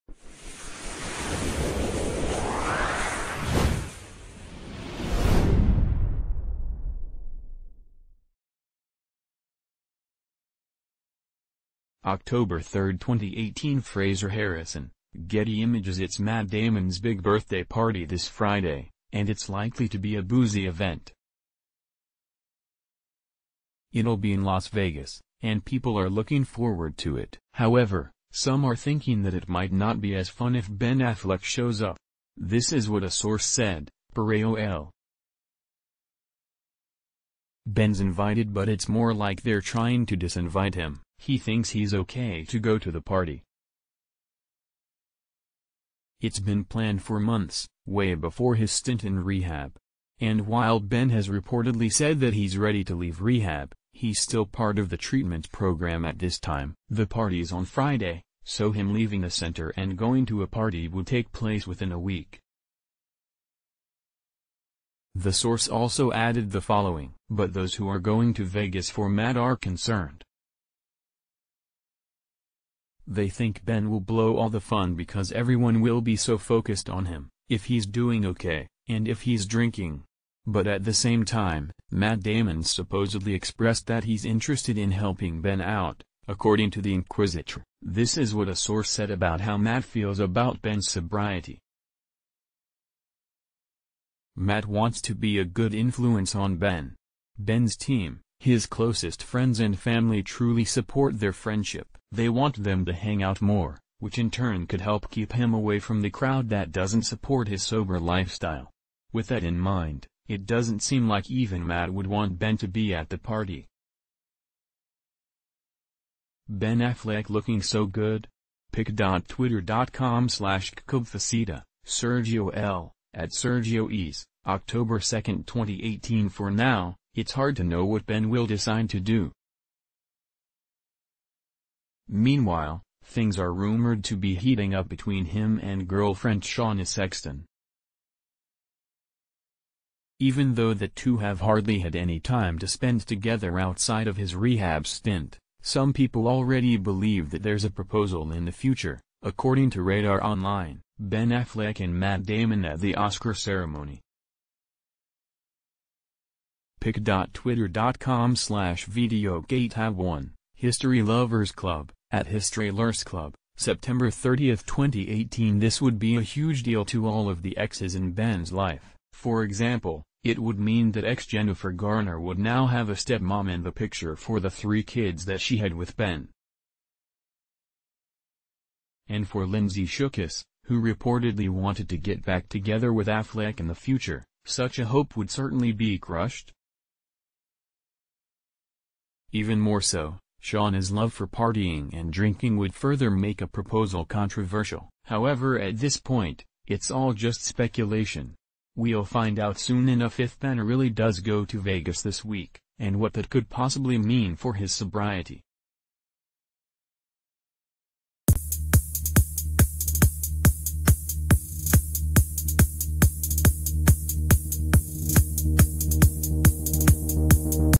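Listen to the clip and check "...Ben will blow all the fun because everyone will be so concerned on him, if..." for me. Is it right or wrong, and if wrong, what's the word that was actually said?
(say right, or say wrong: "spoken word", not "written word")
wrong: "focused", not "concerned".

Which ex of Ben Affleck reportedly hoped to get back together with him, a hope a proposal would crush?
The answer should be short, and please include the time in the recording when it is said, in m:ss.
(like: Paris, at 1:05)
Lindsay Shookus, at 2:59.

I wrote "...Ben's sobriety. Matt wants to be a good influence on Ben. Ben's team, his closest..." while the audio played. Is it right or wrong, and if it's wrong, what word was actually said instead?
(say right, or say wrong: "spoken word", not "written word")
right.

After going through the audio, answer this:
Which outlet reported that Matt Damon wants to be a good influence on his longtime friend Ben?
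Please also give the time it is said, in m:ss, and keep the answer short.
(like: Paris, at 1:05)
Inquisitr, at 1:26.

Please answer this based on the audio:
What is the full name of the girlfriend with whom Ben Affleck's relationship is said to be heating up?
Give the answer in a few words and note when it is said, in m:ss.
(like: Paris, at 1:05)
Shauna Sexton, at 2:16.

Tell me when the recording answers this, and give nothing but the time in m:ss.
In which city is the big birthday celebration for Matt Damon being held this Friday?
0:24.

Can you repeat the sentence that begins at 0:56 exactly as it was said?
The party's on Friday, so him leaving the center and going to a party would take place within a week.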